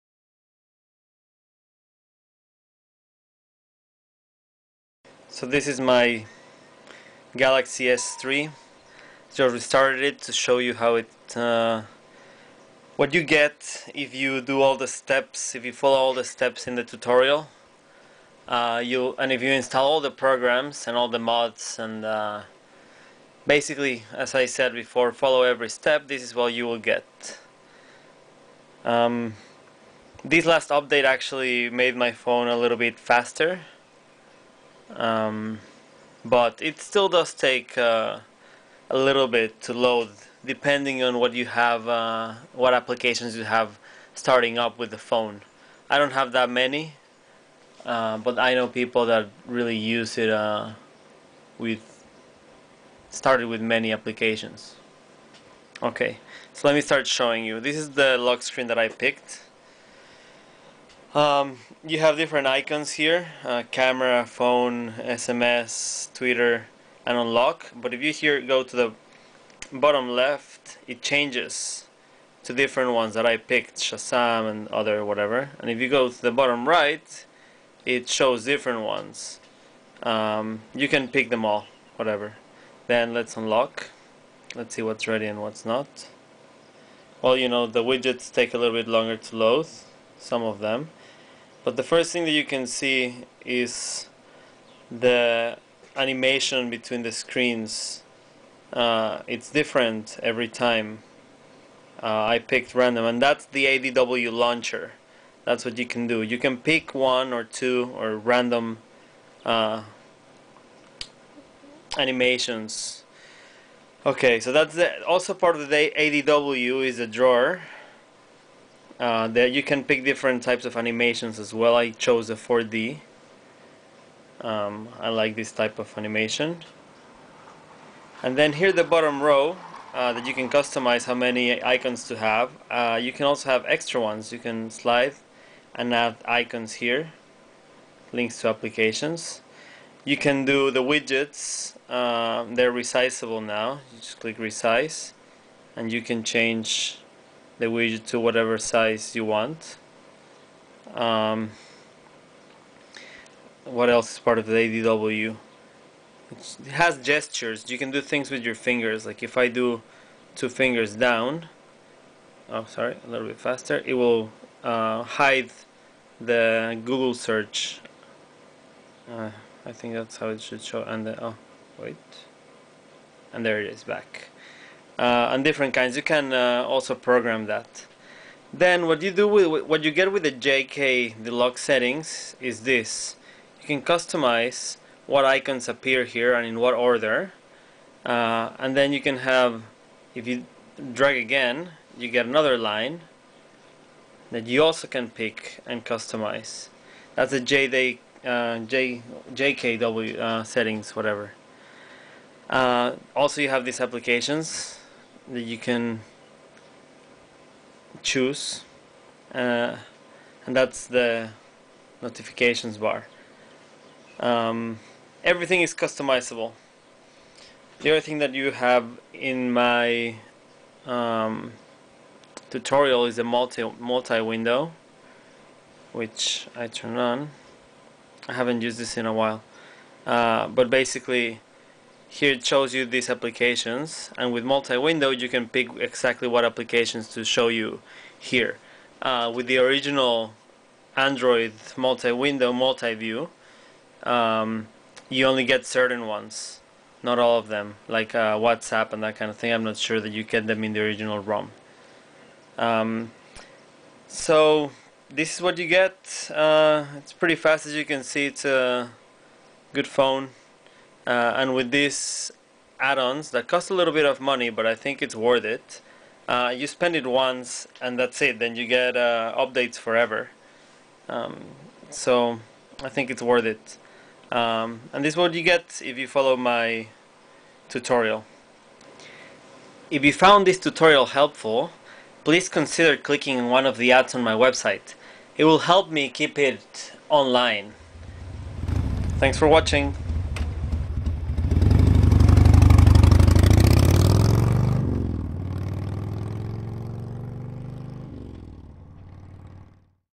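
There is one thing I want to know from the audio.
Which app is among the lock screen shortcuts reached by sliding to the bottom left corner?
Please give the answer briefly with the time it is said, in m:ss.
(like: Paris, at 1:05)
Shazam, at 1:13.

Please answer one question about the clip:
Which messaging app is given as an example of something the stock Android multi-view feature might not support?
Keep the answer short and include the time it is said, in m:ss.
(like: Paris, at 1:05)
WhatsApp, at 4:08.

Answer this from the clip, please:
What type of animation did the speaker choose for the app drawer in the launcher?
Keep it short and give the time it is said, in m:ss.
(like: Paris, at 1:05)
4D, at 2:02.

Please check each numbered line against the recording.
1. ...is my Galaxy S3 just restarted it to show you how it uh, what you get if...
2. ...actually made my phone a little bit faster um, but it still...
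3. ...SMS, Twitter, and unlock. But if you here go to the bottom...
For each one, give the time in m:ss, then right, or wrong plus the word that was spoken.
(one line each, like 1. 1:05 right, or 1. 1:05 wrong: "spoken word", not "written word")
1. 0:05 right
2. 0:31 right
3. 1:05 right.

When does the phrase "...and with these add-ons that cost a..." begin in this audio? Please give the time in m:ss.
4:21.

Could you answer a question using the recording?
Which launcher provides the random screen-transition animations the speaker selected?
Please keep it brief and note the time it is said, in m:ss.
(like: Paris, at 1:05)
ADW launcher, at 1:43.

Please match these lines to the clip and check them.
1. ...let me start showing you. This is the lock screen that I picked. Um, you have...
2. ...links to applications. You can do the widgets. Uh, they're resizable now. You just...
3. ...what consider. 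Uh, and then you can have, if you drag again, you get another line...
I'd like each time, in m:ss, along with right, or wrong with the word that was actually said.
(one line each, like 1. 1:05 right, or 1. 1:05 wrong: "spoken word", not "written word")
1. 0:56 right
2. 2:18 right
3. 3:06 wrong: "order", not "consider".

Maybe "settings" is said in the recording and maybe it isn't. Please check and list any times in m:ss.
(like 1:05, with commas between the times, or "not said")
3:01, 3:20.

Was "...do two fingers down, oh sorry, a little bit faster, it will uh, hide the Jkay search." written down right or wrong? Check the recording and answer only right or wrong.
wrong.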